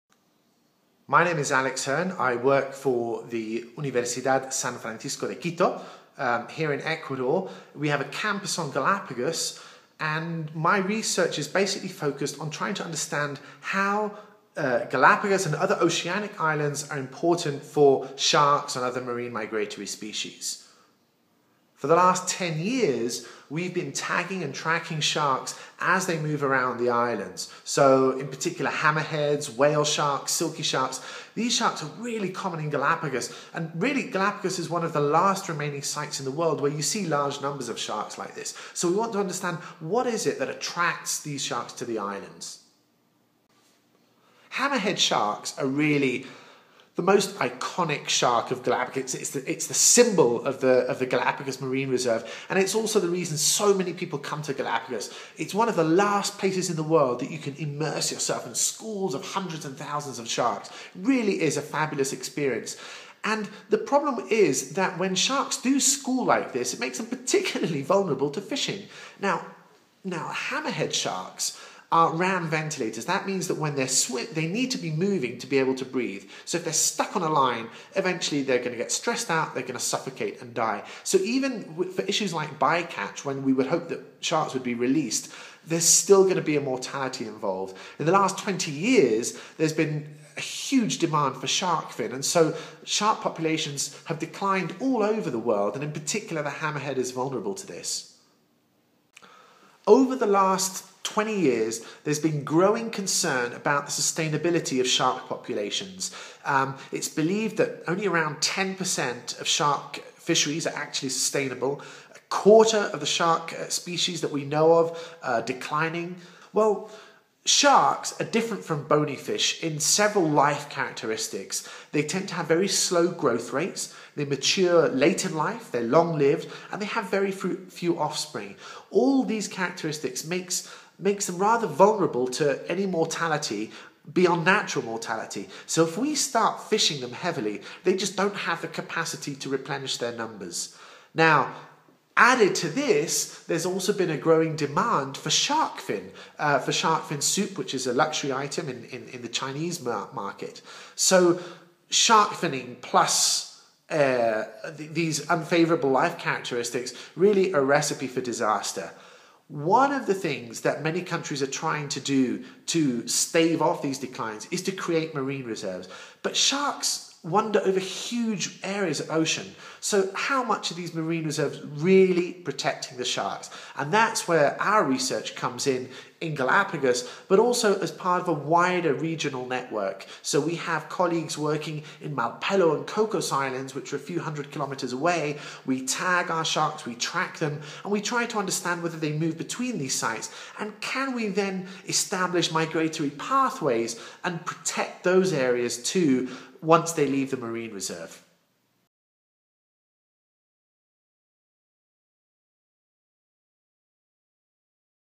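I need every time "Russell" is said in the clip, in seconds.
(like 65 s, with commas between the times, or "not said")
not said.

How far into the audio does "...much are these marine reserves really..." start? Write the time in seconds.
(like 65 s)
170 s.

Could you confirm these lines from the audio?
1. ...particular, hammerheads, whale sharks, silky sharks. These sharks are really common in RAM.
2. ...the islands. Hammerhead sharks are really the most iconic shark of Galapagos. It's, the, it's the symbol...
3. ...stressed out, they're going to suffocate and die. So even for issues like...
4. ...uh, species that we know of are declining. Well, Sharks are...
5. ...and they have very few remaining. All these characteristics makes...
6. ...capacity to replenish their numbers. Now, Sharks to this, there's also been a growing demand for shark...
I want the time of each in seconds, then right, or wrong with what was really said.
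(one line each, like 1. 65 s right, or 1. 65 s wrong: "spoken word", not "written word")
1. 28 s wrong: "Galapagos", not "RAM"
2. 41 s right
3. 78 s right
4. 113 s right
5. 126 s wrong: "offspring", not "remaining"
6. 138 s wrong: "Added", not "Sharks".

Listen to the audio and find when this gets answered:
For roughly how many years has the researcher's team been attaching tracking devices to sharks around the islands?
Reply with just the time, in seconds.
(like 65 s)
22 s.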